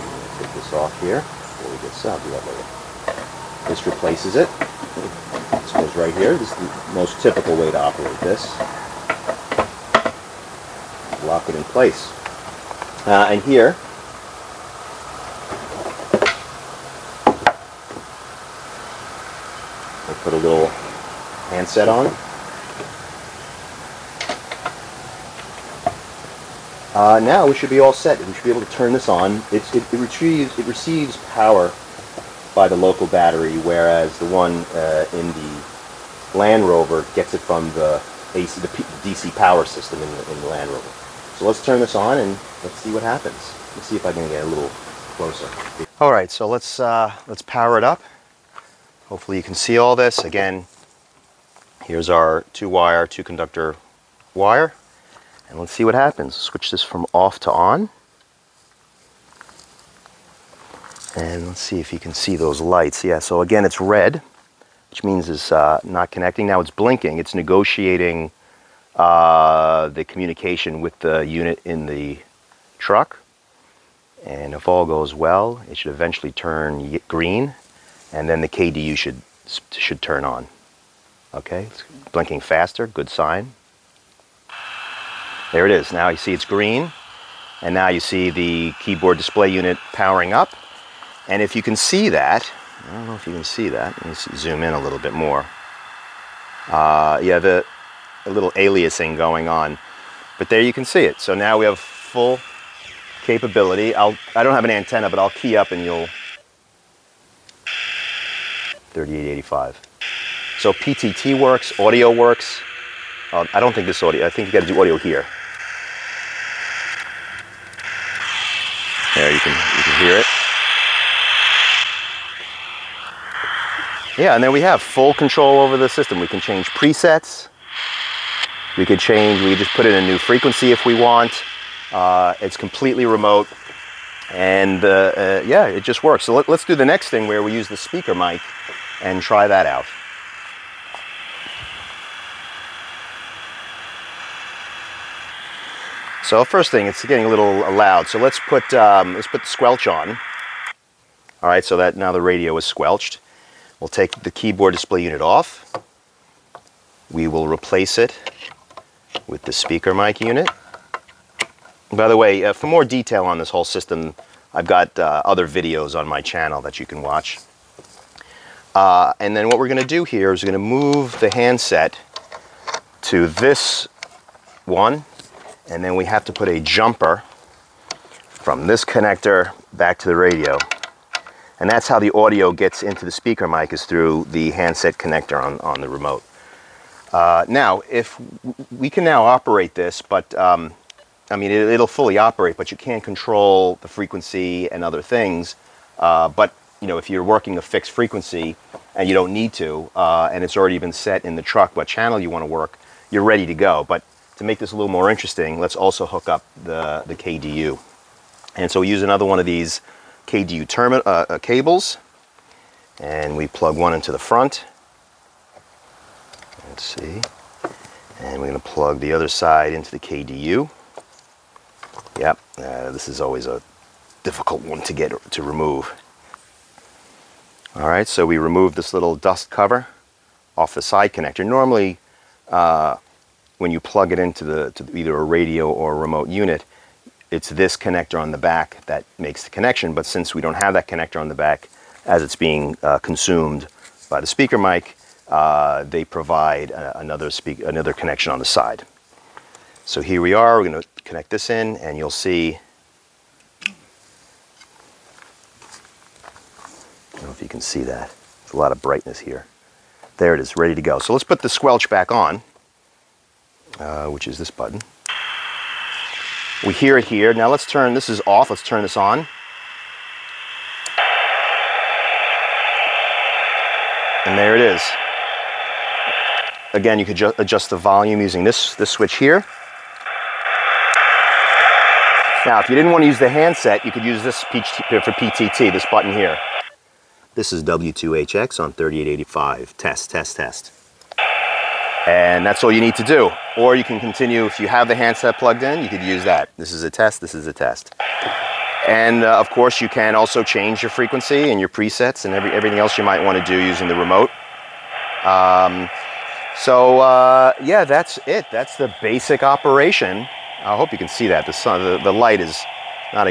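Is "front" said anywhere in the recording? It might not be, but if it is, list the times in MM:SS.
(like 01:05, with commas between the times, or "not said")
03:34.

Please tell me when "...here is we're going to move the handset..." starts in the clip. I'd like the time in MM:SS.
02:50.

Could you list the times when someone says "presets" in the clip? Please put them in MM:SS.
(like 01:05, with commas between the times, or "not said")
02:06, 05:01.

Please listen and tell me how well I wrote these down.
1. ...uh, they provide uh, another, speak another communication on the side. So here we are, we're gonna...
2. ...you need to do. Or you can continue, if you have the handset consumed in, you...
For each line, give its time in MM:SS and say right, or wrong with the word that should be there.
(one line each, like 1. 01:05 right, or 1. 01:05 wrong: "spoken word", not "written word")
1. 04:05 wrong: "connection", not "communication"
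2. 04:52 wrong: "plugged", not "consumed".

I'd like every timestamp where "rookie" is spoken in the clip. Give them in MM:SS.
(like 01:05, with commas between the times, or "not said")
not said.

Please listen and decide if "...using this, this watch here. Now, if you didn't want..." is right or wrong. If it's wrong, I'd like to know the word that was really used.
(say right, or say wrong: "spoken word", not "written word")
wrong: "switch", not "watch".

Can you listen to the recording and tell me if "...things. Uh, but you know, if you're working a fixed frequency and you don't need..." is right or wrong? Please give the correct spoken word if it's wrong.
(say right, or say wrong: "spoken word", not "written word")
right.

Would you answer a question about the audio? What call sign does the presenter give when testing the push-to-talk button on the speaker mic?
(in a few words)
W2HX.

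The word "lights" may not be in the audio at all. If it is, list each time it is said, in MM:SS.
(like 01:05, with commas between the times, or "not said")
01:02, 05:12.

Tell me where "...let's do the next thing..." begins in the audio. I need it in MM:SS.
02:16.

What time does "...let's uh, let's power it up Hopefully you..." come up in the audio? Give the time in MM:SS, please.
00:46.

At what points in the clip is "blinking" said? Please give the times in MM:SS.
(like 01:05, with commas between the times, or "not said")
01:06, 01:22.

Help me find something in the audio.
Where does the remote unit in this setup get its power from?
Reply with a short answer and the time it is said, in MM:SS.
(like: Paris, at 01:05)
Local battery, at 00:32.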